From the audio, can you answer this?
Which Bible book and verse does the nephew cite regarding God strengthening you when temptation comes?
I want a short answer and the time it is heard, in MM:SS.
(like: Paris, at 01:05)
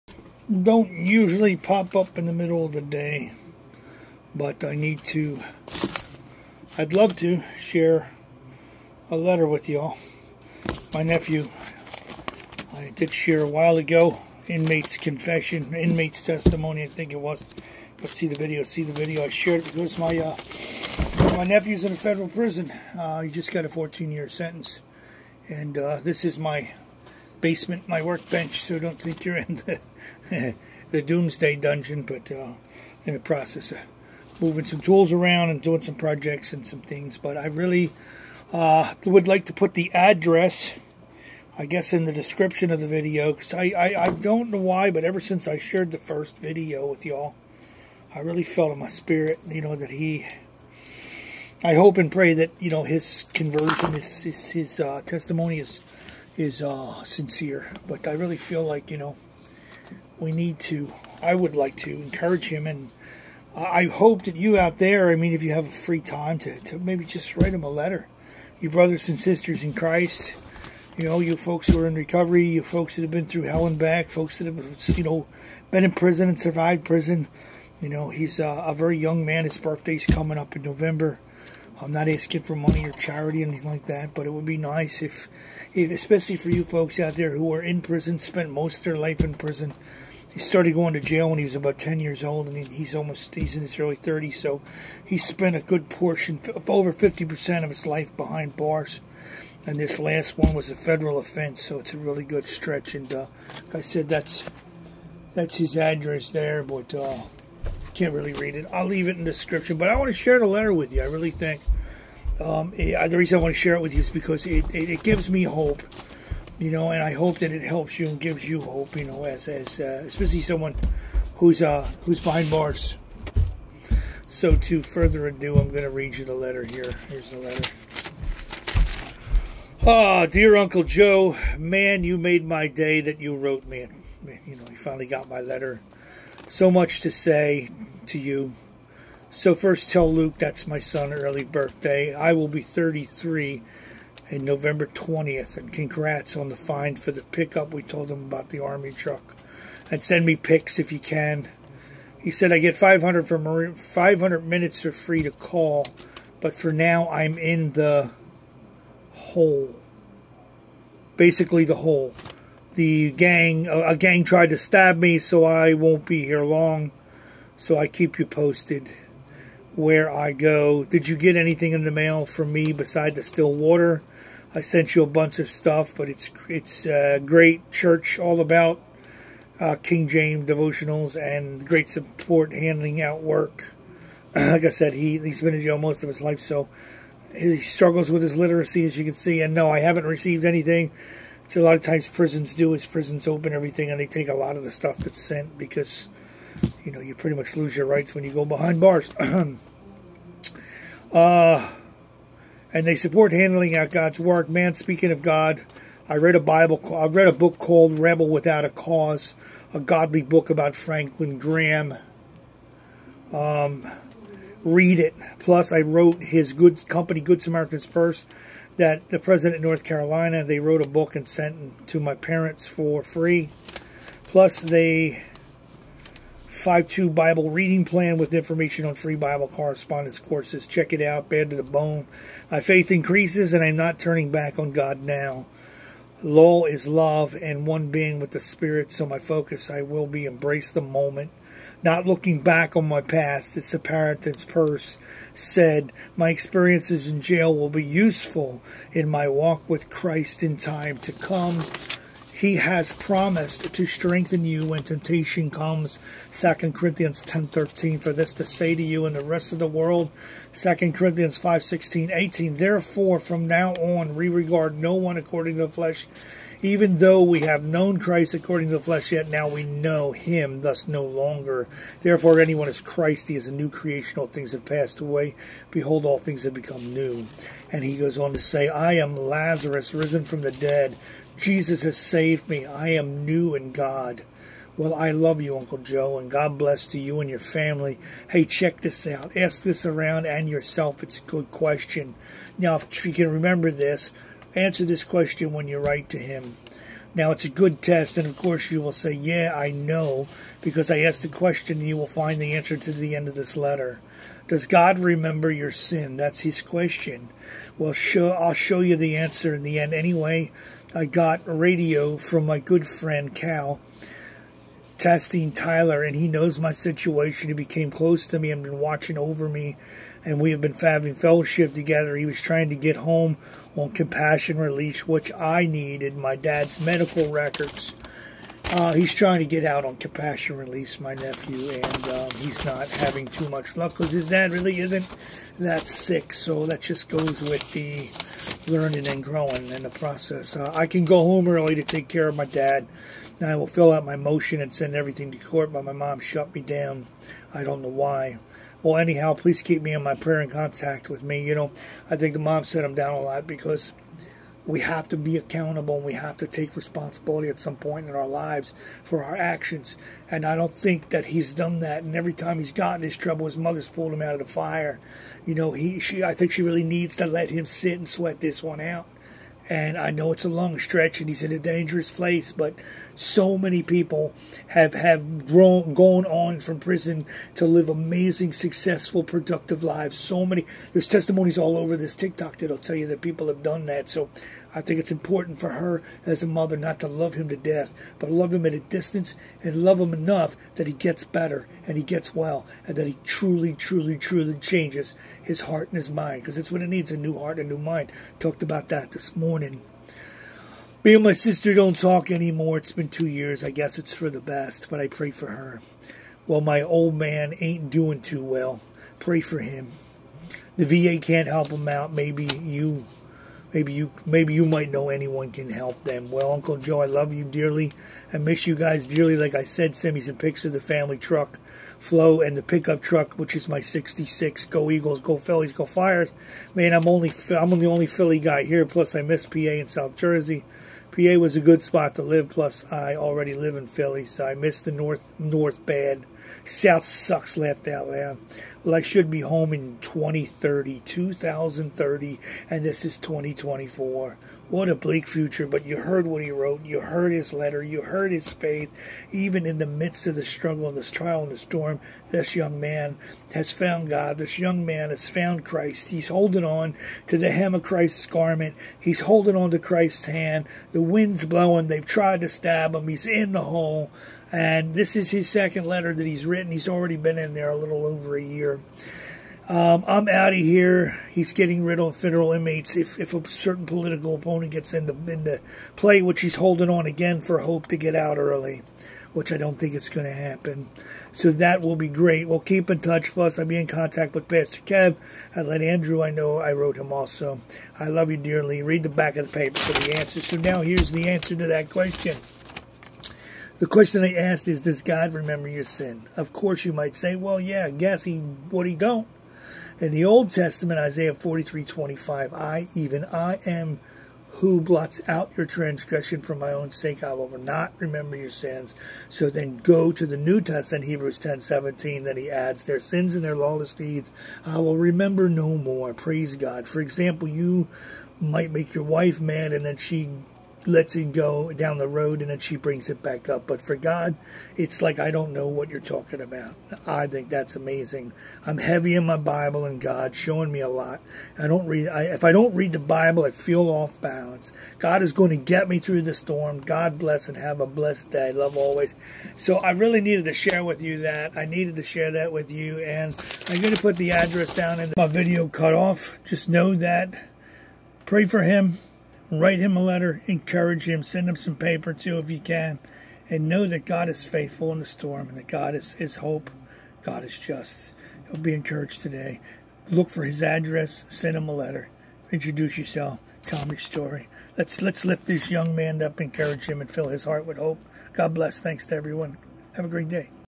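2 Corinthians 10:13, at 04:16.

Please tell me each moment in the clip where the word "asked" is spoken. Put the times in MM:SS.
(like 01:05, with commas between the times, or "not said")
05:00, 08:14.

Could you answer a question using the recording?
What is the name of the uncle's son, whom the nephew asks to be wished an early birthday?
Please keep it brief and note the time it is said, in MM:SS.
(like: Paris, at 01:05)
Luke, at 02:20.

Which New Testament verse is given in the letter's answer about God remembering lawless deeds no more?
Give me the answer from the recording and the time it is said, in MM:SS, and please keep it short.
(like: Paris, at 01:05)
Hebrews 10:17, at 08:31.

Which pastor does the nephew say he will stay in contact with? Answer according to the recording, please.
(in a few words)
Pastor Kev.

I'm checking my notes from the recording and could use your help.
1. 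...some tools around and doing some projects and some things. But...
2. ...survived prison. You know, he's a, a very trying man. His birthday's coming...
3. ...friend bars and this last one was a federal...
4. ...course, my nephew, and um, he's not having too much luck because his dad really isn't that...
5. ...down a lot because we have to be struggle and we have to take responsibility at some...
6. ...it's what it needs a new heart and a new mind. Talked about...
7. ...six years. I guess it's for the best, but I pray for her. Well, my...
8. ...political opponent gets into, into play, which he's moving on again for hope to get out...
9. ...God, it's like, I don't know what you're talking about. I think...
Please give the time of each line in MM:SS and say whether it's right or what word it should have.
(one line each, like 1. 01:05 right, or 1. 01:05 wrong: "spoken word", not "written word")
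1. 00:34 right
2. 01:16 wrong: "young", not "trying"
3. 01:38 wrong: "behind", not "friend"
4. 05:30 wrong: "release", not "course"
5. 05:52 wrong: "accountable", not "struggle"
6. 06:36 right
7. 06:43 wrong: "two", not "six"
8. 07:53 wrong: "holding", not "moving"
9. 08:43 right.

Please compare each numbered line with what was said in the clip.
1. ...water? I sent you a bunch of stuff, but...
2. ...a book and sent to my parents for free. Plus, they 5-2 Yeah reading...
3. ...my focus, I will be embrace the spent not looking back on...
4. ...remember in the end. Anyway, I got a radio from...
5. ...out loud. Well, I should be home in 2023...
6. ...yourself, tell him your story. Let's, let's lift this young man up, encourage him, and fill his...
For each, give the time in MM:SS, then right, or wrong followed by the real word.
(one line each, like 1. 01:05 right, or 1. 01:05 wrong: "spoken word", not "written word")
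1. 02:53 right
2. 03:40 wrong: "Bible", not "Yeah"
3. 03:59 wrong: "moment", not "spent"
4. 05:09 wrong: "answer", not "remember"
5. 07:17 wrong: "2030", not "2023"
6. 09:22 right.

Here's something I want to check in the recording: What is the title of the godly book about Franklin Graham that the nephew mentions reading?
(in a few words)
Rebel Without a Cause.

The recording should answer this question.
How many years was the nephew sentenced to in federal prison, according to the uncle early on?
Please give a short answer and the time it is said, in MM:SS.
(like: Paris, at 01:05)
14, at 00:23.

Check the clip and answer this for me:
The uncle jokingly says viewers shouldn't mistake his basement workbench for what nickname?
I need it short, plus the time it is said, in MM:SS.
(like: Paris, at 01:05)
Doomsday Dungeon, at 00:31.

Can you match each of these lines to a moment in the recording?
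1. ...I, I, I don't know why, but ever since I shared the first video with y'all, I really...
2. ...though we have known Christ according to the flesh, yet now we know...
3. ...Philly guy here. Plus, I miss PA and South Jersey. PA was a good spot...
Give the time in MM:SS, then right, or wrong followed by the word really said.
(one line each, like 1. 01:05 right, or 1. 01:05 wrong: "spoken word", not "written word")
1. 00:43 right
2. 04:26 right
3. 07:08 right.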